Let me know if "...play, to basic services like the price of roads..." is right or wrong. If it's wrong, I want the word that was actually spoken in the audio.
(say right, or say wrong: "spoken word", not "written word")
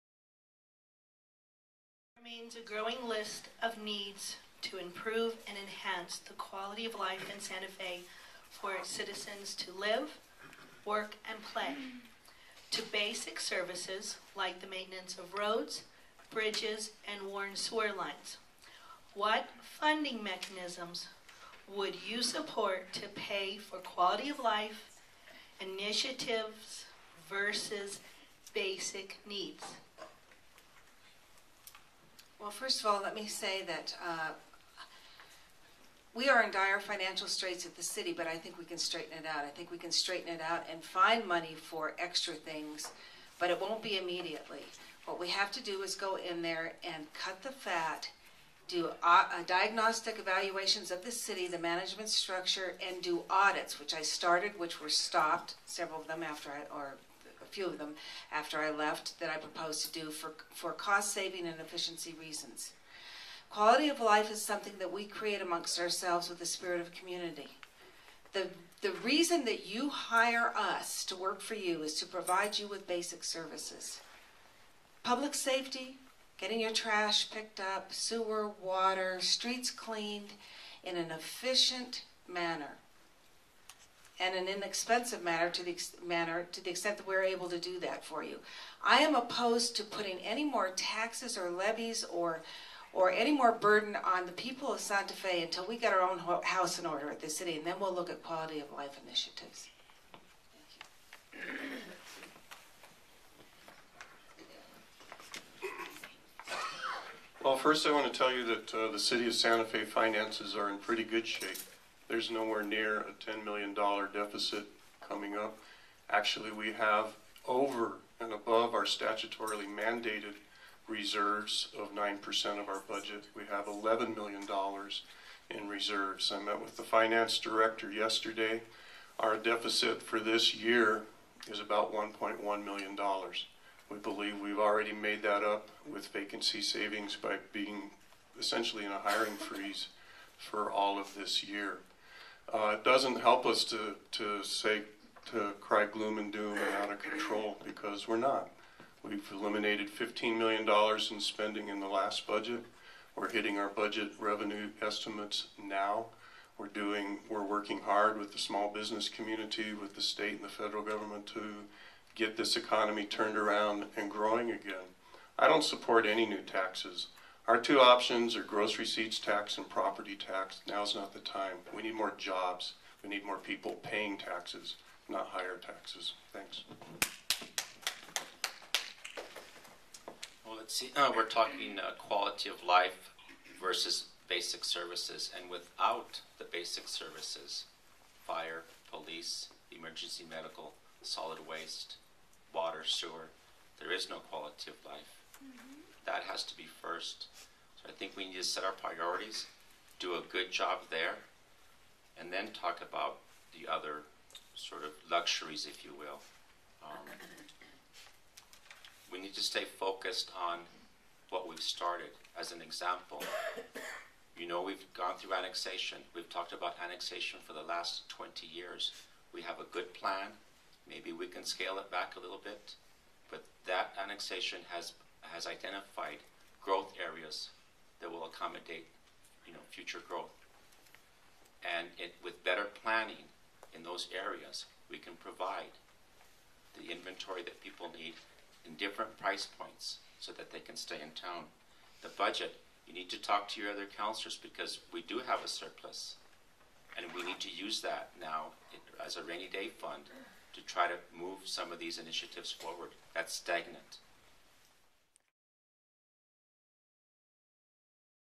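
wrong: "maintenance", not "price".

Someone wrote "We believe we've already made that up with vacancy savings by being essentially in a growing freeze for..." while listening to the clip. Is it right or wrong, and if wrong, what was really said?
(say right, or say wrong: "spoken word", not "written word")
wrong: "hiring", not "growing".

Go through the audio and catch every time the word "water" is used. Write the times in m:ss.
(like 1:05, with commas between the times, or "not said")
1:18, 3:12.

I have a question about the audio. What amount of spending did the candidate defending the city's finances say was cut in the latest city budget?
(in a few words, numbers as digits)
$15 million.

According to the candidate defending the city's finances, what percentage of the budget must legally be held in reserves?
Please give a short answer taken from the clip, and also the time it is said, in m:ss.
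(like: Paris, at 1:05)
9%, at 2:01.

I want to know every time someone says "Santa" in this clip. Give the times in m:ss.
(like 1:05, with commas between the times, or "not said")
0:07, 1:34, 1:49.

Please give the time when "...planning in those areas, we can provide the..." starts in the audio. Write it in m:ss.
3:52.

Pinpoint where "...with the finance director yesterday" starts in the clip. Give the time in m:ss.
2:06.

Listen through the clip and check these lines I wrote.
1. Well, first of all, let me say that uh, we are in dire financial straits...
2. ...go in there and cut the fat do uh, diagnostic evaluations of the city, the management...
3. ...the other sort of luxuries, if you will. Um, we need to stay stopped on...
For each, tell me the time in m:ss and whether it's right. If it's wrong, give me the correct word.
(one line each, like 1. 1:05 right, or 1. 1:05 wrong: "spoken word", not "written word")
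1. 0:32 right
2. 0:45 right
3. 3:23 wrong: "focused", not "stopped".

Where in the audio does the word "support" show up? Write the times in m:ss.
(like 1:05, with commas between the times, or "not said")
0:22, 2:45.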